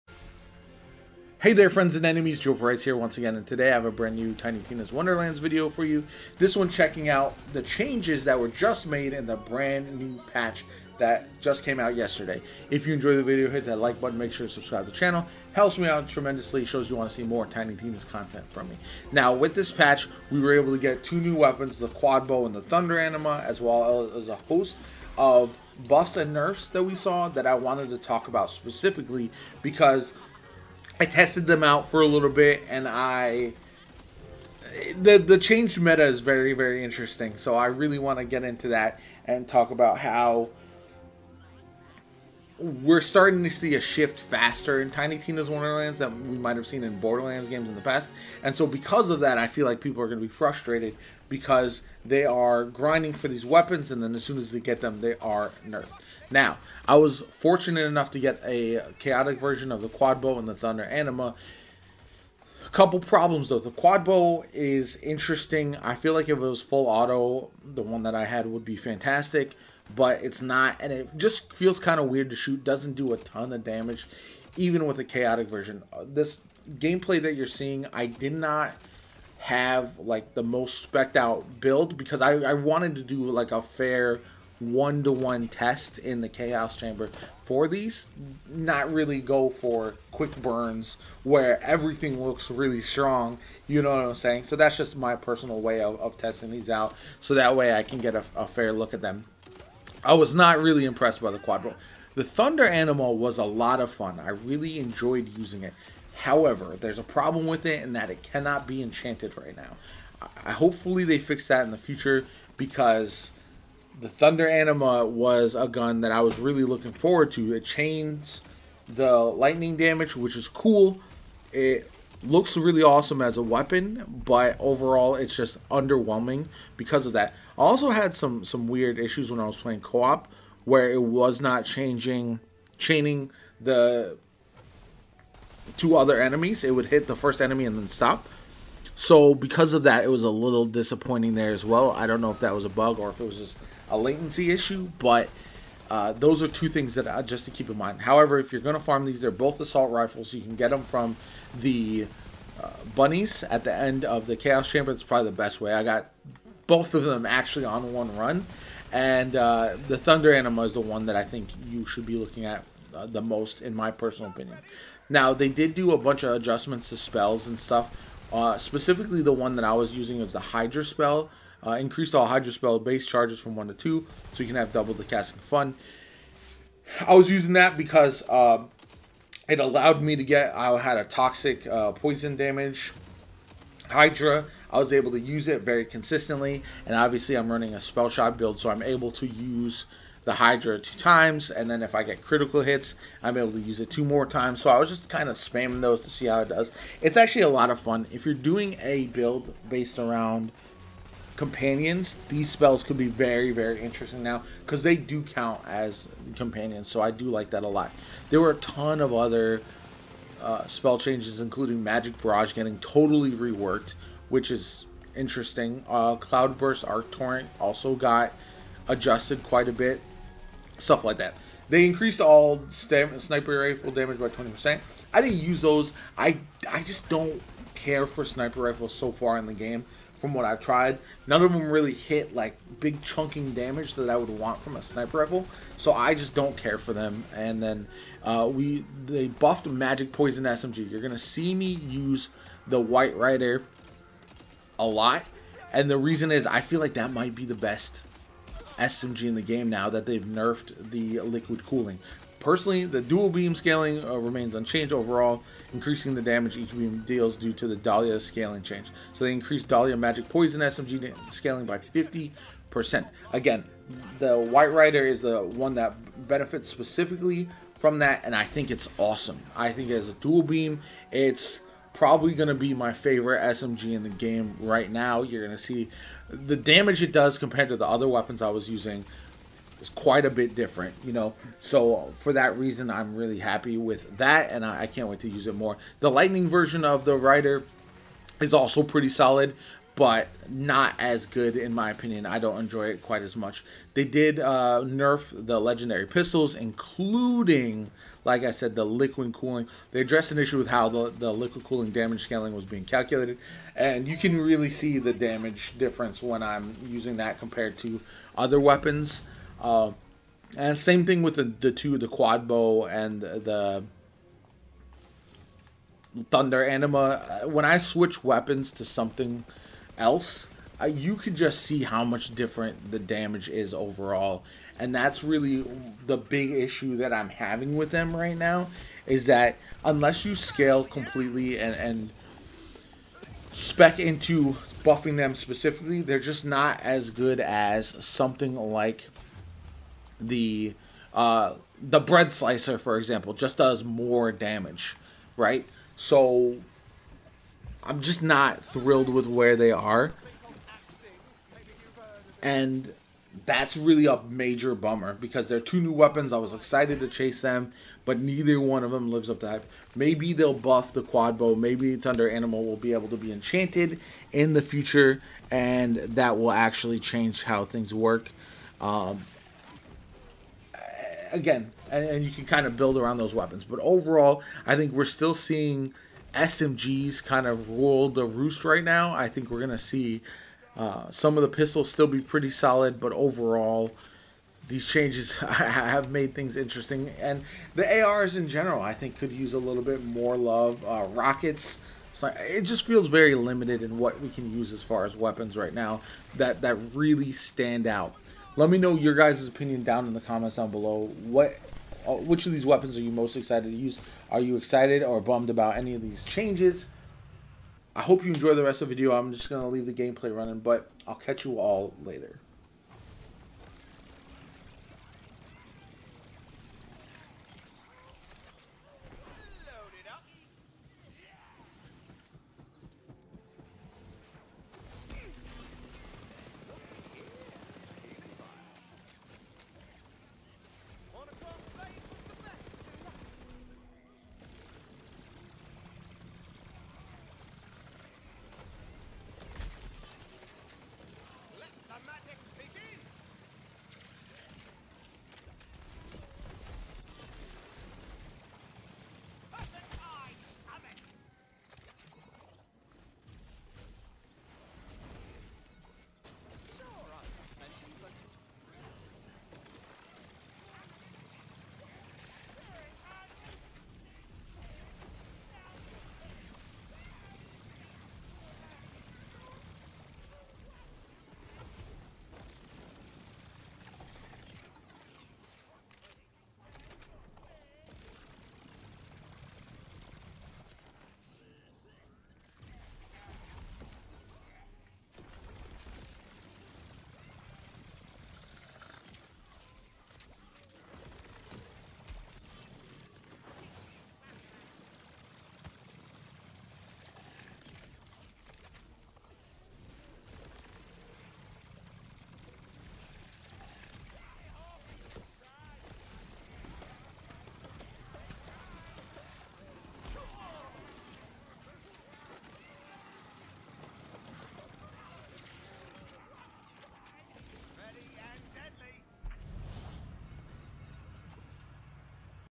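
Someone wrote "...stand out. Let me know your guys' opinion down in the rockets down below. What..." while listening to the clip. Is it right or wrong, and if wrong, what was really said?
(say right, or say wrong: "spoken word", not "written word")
wrong: "comments", not "rockets".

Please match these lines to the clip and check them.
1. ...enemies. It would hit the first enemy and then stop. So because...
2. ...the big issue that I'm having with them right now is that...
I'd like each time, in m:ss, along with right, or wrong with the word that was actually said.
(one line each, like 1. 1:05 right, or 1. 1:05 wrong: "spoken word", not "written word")
1. 2:16 right
2. 5:26 right.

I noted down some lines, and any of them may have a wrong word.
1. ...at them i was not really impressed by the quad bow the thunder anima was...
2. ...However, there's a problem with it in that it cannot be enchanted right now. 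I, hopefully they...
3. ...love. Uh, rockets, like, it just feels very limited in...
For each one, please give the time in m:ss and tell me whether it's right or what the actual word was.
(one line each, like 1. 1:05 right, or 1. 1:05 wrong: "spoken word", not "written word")
1. 1:38 right
2. 1:46 right
3. 6:30 right.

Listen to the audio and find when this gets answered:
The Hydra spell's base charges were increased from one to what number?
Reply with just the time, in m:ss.
2:53.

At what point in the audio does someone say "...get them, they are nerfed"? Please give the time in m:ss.
0:54.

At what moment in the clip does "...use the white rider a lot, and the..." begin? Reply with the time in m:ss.
4:01.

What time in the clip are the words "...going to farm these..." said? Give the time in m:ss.
2:28.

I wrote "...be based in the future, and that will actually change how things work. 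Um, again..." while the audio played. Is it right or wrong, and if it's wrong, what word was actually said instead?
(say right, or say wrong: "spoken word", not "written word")
wrong: "enchanted", not "based".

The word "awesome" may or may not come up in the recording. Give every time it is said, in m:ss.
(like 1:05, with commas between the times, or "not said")
2:02, 4:28.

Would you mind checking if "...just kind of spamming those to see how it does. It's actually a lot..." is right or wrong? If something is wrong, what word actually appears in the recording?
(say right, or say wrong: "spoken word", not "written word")
right.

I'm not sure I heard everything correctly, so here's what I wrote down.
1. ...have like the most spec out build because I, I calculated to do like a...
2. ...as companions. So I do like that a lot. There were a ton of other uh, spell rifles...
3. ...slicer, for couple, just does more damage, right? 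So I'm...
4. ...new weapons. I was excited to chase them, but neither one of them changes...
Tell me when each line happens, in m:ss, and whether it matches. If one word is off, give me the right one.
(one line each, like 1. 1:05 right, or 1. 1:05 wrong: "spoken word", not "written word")
1. 1:19 wrong: "wanted", not "calculated"
2. 3:25 wrong: "changes", not "rifles"
3. 5:42 wrong: "example", not "couple"
4. 5:55 wrong: "lives", not "changes".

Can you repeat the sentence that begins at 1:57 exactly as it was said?
It chains the lightning damage, which is cool.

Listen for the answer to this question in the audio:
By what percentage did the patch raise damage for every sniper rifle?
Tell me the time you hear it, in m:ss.
3:44.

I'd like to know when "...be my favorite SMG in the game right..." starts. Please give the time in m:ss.
4:32.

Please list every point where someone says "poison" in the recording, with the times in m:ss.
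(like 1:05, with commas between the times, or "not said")
3:01, 4:00, 4:20.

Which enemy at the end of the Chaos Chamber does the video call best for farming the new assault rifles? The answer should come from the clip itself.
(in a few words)
bunnies.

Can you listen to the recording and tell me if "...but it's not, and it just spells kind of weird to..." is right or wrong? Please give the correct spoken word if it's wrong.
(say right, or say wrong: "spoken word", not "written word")
wrong: "feels", not "spells".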